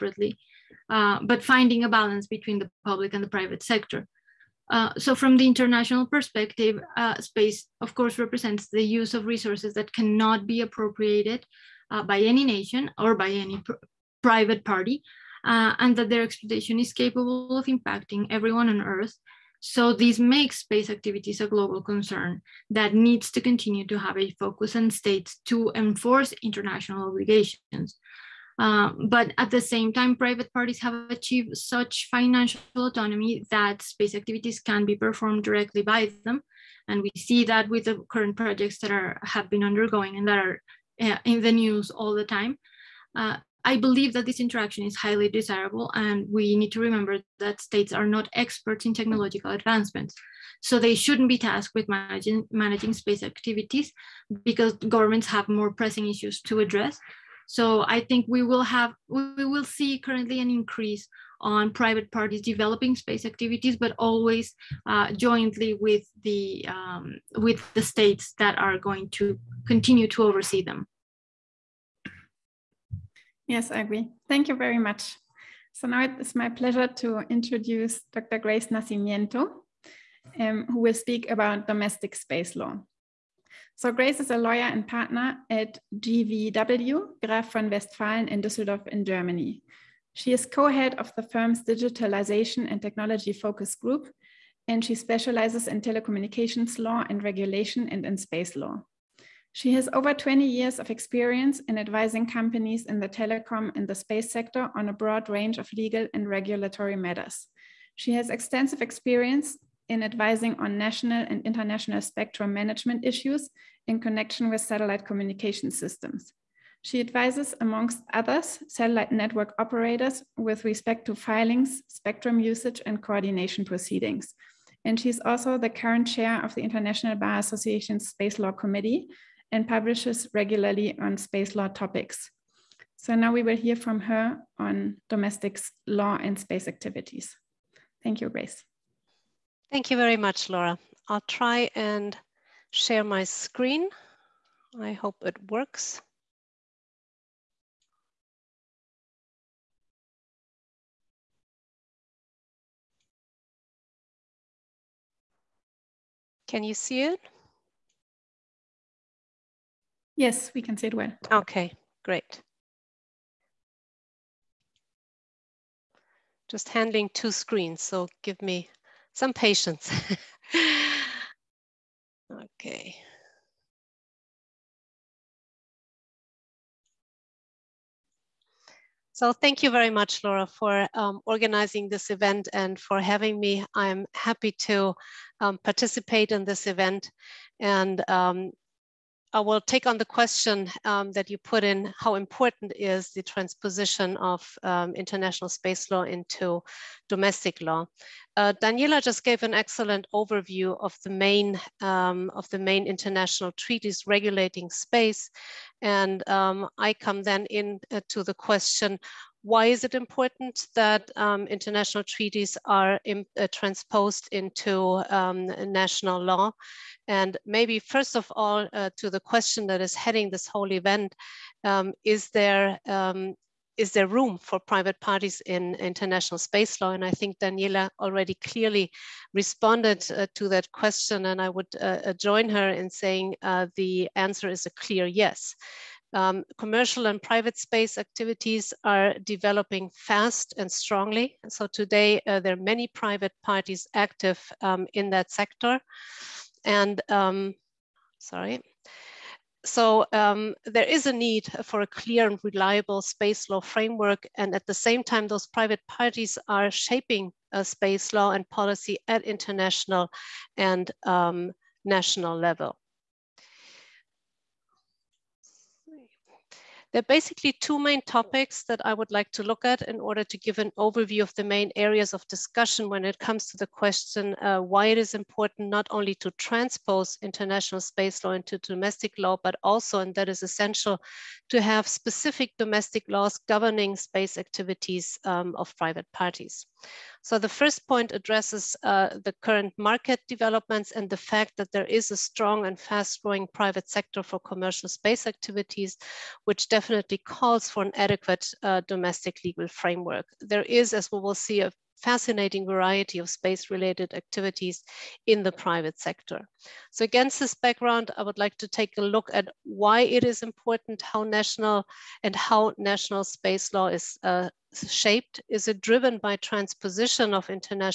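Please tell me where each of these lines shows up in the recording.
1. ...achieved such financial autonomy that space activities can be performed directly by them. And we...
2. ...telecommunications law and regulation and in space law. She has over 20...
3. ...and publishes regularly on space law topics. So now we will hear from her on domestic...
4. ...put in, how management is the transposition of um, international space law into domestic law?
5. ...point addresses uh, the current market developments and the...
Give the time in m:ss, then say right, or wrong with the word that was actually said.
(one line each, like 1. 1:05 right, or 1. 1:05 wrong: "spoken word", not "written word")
1. 0:31 right
2. 1:35 right
3. 2:09 right
4. 3:11 wrong: "important", not "management"
5. 4:47 right.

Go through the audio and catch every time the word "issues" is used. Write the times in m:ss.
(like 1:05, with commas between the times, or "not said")
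0:56, 1:53.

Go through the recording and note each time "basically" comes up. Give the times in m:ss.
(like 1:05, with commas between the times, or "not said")
4:27.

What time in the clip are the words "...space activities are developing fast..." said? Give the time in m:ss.
3:57.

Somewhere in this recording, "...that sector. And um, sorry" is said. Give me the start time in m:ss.
4:05.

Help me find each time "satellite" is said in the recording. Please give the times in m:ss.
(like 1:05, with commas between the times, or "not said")
1:54, 1:58.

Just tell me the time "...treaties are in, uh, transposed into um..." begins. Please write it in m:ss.
3:32.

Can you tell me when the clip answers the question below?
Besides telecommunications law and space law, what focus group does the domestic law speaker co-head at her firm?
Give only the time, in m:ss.
1:31.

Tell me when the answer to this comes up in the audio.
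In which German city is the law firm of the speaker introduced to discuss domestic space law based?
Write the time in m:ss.
1:28.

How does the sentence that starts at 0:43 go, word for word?
Uh, I believe that this interaction is highly desirable, and we need to remember that states are not experts in technological advancements.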